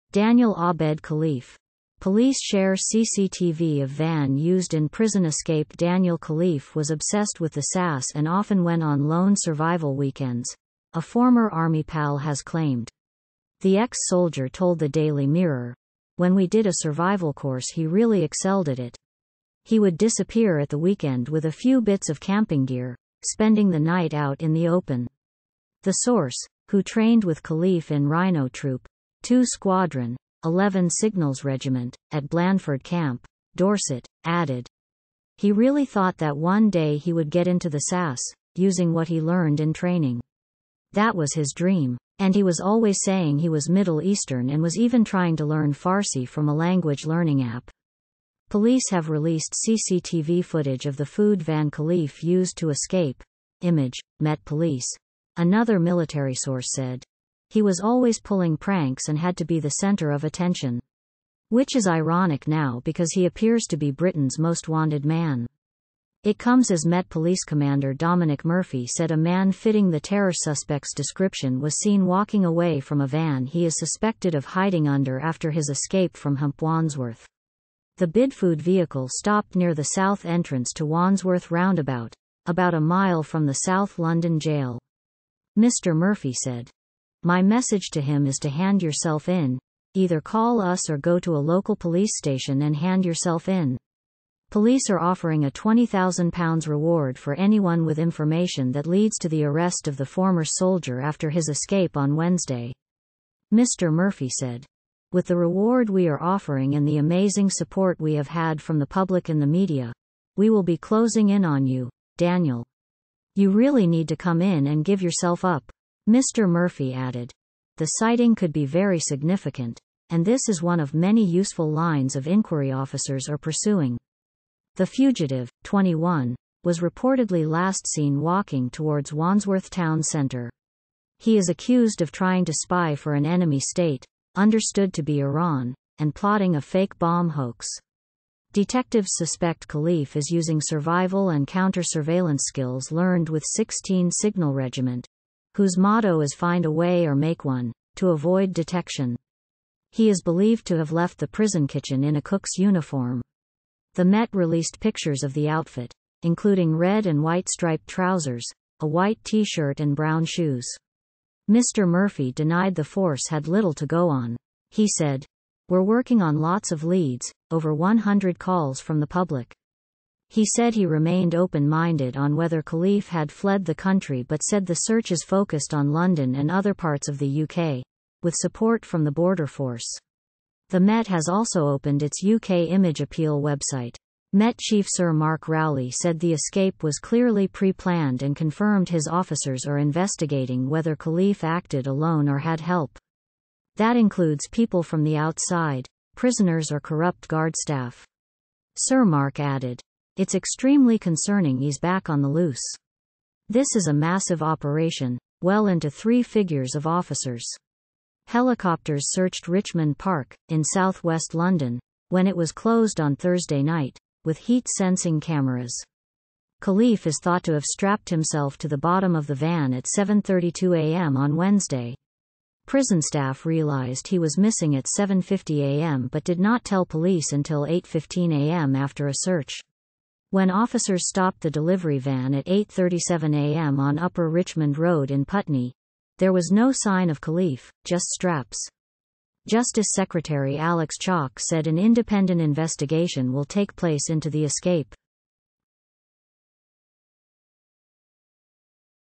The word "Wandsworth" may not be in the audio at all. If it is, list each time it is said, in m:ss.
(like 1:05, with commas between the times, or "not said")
1:16, 1:20, 2:09.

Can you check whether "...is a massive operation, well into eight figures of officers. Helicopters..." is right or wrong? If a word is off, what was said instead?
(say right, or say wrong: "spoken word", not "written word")
wrong: "three", not "eight".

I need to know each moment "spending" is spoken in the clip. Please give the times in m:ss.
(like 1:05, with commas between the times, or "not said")
0:23.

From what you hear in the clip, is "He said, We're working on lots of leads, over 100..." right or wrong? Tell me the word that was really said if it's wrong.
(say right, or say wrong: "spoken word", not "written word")
right.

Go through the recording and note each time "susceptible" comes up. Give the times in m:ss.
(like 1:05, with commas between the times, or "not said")
not said.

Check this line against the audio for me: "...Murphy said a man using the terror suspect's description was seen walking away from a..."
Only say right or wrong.
wrong.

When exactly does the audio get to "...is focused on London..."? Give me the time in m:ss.
2:55.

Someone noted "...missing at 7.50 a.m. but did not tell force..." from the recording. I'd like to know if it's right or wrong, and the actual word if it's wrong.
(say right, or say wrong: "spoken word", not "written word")
wrong: "police", not "force".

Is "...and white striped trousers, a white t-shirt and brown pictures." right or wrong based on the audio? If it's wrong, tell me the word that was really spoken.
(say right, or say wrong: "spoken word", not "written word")
wrong: "shoes", not "pictures".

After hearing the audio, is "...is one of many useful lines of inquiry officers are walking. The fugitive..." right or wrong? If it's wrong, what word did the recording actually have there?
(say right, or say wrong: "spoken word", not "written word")
wrong: "pursuing", not "walking".